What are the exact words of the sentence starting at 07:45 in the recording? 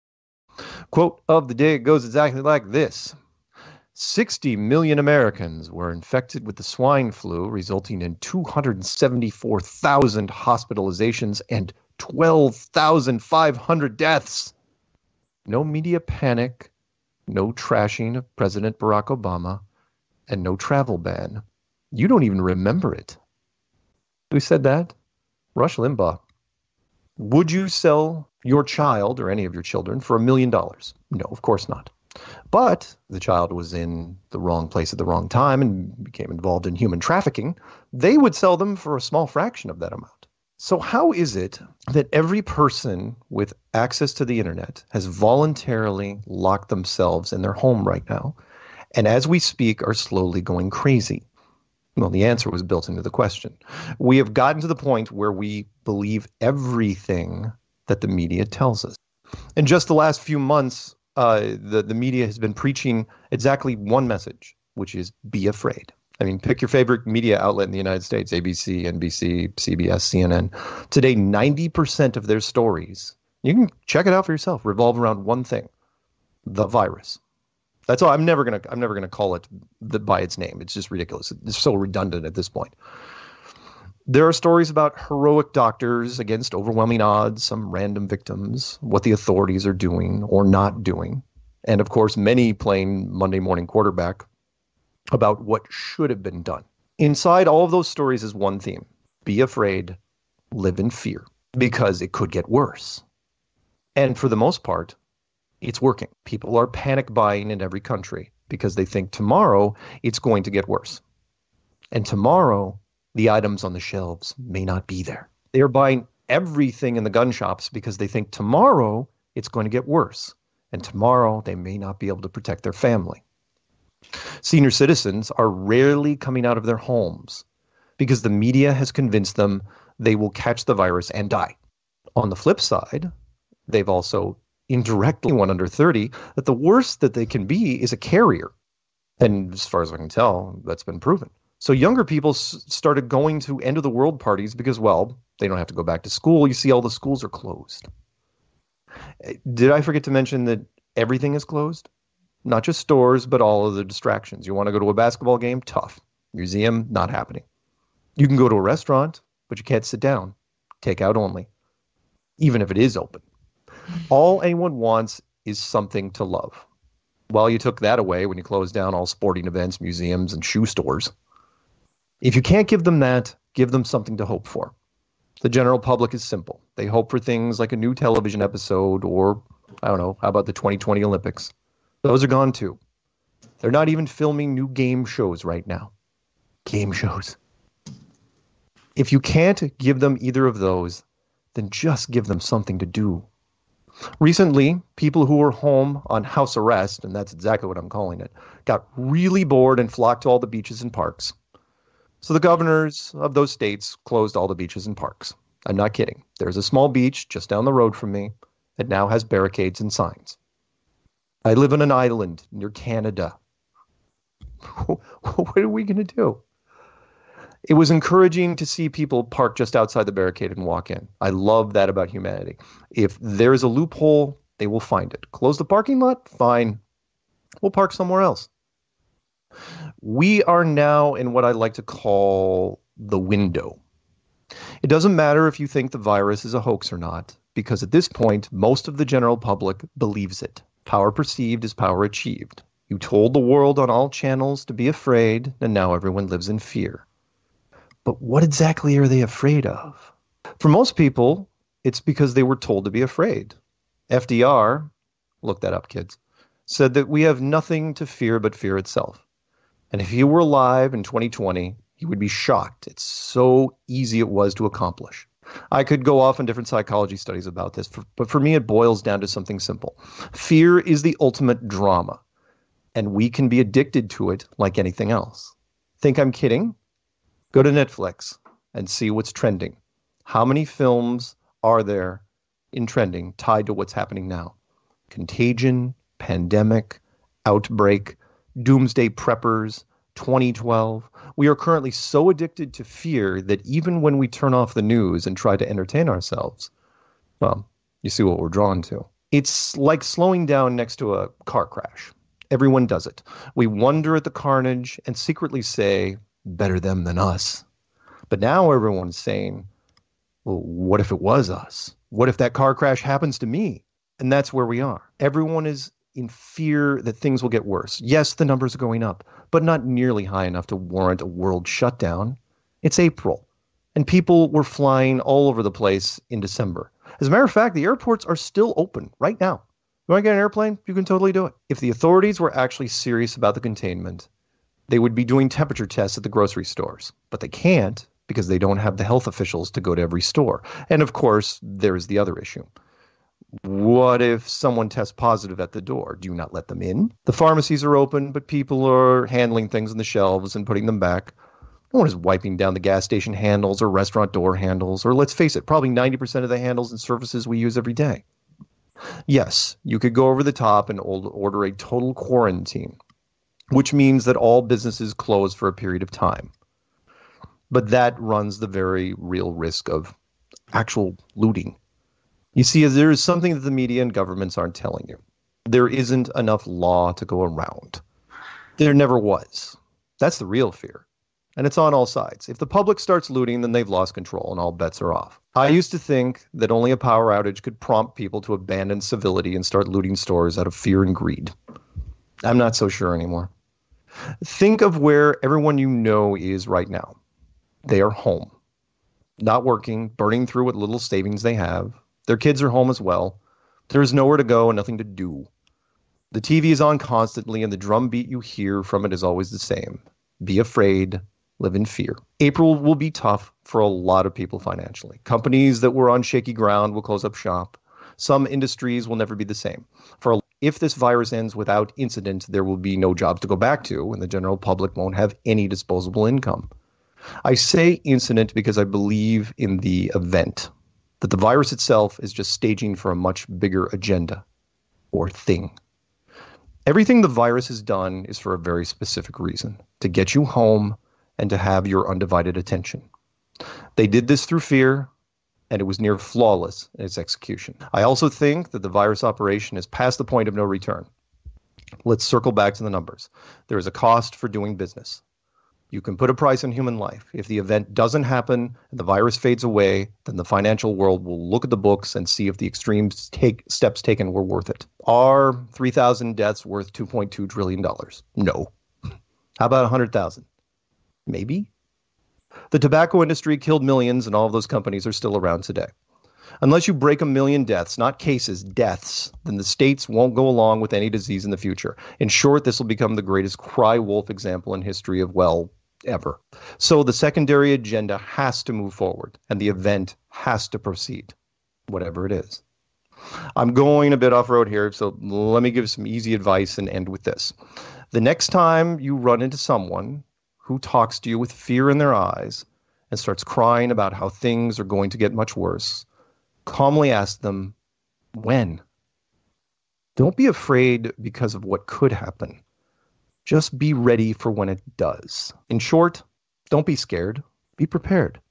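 Are 3,000 deaths worth $2.2 trillion?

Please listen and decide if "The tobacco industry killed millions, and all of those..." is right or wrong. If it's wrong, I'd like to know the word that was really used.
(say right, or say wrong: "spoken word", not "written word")
right.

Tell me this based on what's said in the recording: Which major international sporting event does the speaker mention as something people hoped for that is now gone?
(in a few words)
2020 Olympics.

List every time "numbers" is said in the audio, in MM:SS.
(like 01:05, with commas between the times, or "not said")
05:18, 07:32.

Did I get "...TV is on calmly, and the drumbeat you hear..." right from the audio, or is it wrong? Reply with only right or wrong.
wrong.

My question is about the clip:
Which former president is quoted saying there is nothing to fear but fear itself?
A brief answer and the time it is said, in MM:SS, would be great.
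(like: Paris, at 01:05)
FDR, at 04:14.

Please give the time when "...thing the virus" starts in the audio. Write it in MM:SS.
01:15.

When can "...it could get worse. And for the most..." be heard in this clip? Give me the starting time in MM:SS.
01:42.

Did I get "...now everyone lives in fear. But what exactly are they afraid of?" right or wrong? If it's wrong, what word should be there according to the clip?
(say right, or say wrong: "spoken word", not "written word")
right.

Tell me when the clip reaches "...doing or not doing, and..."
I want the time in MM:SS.
01:29.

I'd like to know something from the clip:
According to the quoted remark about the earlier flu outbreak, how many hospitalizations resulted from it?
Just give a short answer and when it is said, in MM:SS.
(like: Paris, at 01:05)
274,000, at 00:08.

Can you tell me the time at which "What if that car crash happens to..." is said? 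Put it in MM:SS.
05:12.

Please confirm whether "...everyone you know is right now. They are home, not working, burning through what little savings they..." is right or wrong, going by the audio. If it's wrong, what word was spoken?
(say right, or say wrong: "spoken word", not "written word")
right.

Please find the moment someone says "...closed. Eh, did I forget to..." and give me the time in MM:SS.
02:27.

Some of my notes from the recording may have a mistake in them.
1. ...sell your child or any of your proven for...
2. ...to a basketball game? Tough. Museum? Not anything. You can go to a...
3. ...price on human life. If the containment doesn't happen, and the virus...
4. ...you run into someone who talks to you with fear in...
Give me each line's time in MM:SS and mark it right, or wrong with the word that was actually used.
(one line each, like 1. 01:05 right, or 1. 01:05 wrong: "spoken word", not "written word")
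1. 00:27 wrong: "children", not "proven"
2. 02:34 wrong: "happening", not "anything"
3. 07:36 wrong: "event", not "containment"
4. 08:18 right.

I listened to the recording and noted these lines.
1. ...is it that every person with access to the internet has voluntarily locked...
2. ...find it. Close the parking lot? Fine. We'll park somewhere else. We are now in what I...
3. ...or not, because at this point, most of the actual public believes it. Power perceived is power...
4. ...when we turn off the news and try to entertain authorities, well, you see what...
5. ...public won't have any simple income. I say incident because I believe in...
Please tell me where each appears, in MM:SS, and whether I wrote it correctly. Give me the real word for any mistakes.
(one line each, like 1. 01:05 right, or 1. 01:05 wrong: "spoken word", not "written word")
1. 00:41 right
2. 03:44 right
3. 03:56 wrong: "general", not "actual"
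4. 04:54 wrong: "ourselves", not "authorities"
5. 07:04 wrong: "disposable", not "simple".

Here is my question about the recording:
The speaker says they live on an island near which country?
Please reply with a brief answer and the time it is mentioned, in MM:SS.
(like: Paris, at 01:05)
Canada, at 03:32.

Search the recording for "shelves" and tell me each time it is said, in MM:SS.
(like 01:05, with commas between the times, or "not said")
01:53, 05:50.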